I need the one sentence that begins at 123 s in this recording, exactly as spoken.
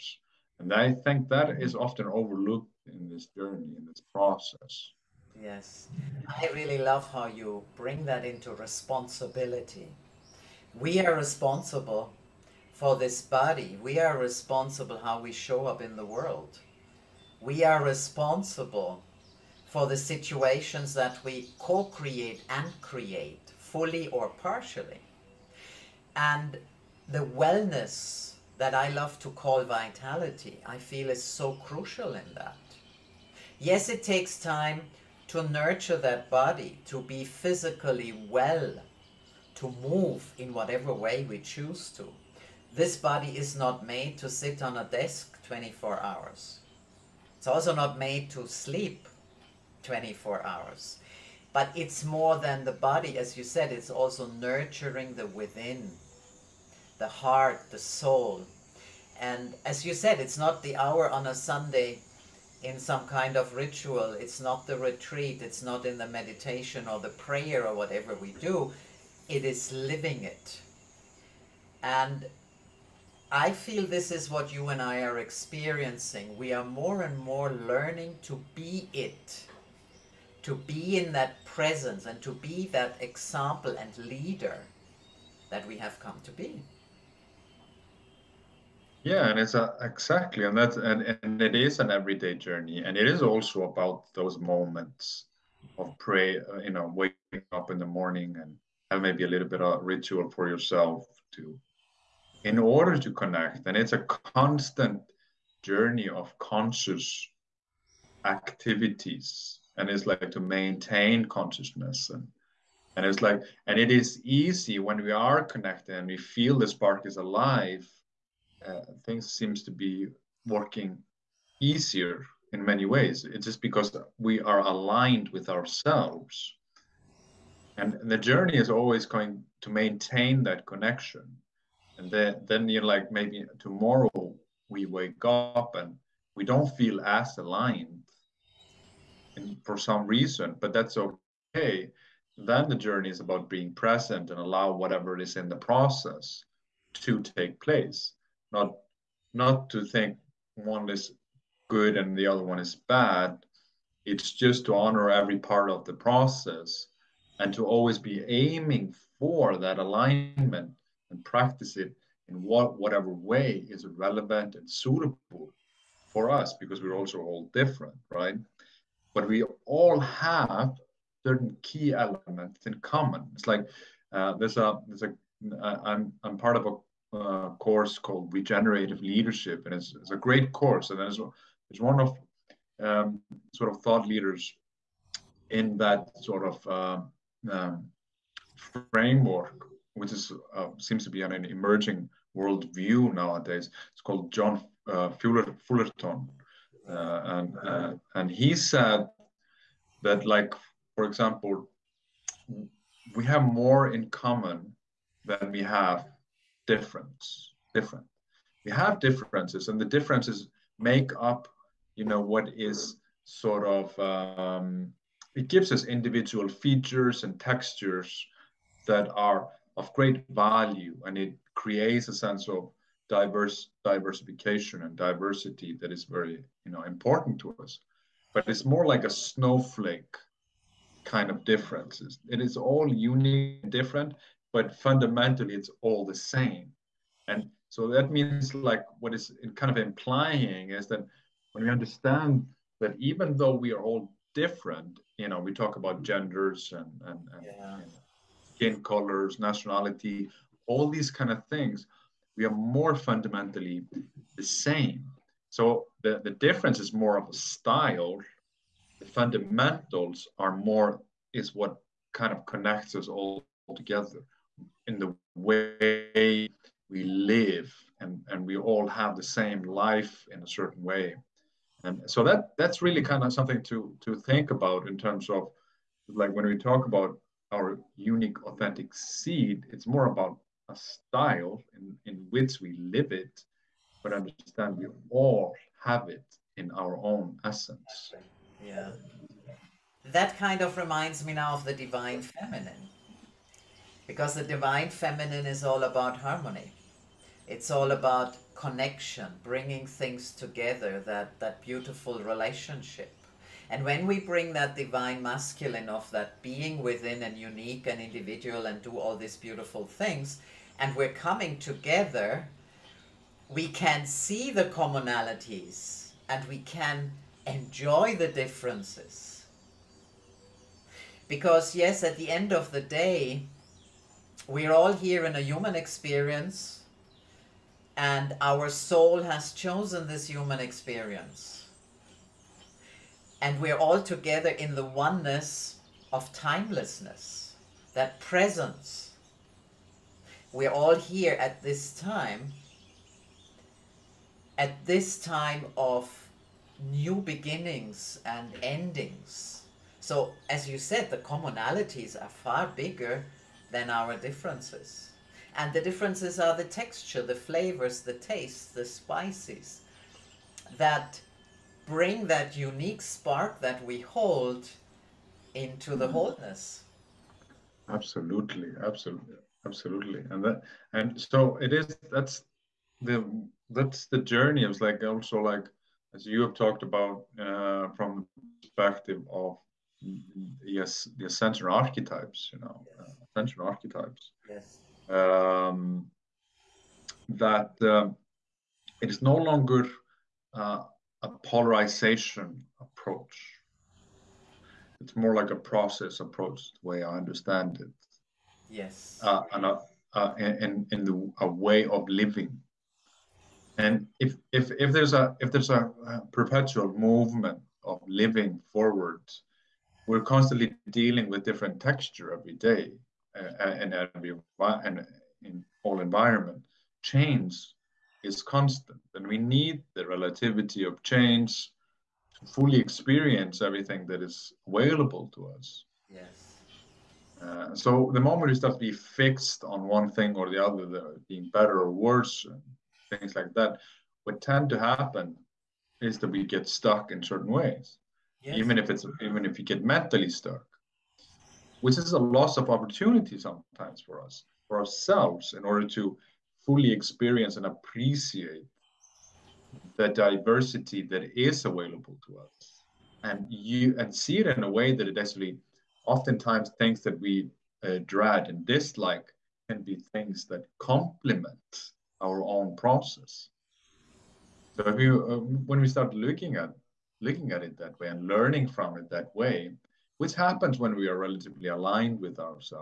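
It's just because we are aligned with ourselves.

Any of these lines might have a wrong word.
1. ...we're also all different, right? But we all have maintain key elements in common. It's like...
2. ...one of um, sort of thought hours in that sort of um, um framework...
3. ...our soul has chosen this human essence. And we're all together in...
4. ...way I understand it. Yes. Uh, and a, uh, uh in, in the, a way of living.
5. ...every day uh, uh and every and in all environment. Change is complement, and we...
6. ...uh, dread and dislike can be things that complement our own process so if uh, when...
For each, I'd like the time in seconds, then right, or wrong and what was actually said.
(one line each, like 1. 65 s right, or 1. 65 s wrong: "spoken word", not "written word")
1. 166 s wrong: "certain", not "maintain"
2. 181 s wrong: "leaders", not "hours"
3. 328 s wrong: "experience", not "essence"
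4. 396 s right
5. 412 s wrong: "constant", not "complement"
6. 457 s right.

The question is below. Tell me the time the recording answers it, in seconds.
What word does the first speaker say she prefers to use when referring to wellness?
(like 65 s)
29 s.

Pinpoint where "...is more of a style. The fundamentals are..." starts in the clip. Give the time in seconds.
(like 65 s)
256 s.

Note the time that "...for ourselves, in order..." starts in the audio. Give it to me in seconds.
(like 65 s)
444 s.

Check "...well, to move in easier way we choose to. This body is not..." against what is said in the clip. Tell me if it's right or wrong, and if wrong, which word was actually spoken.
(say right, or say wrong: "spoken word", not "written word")
wrong: "whatever", not "easier".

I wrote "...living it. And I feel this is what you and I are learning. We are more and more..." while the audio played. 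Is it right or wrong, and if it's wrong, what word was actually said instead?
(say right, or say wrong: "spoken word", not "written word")
wrong: "experiencing", not "learning".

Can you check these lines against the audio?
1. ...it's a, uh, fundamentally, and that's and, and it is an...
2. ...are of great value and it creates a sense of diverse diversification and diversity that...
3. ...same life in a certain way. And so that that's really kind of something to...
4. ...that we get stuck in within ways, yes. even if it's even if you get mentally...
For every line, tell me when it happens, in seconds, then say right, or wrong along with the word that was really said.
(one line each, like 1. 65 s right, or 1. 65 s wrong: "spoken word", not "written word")
1. 89 s wrong: "exactly", not "fundamentally"
2. 219 s right
3. 269 s right
4. 436 s wrong: "certain", not "within".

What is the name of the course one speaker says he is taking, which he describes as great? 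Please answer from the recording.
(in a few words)
Regenerative Leadership.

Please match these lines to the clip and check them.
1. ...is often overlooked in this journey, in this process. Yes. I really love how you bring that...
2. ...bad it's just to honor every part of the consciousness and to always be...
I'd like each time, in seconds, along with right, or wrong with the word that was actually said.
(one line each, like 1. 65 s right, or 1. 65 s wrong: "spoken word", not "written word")
1. 1 s right
2. 152 s wrong: "process", not "consciousness".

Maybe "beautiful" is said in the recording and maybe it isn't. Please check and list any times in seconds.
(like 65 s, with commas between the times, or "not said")
301 s, 309 s.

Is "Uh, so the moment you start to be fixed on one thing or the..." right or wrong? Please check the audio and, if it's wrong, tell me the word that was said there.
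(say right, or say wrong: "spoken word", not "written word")
right.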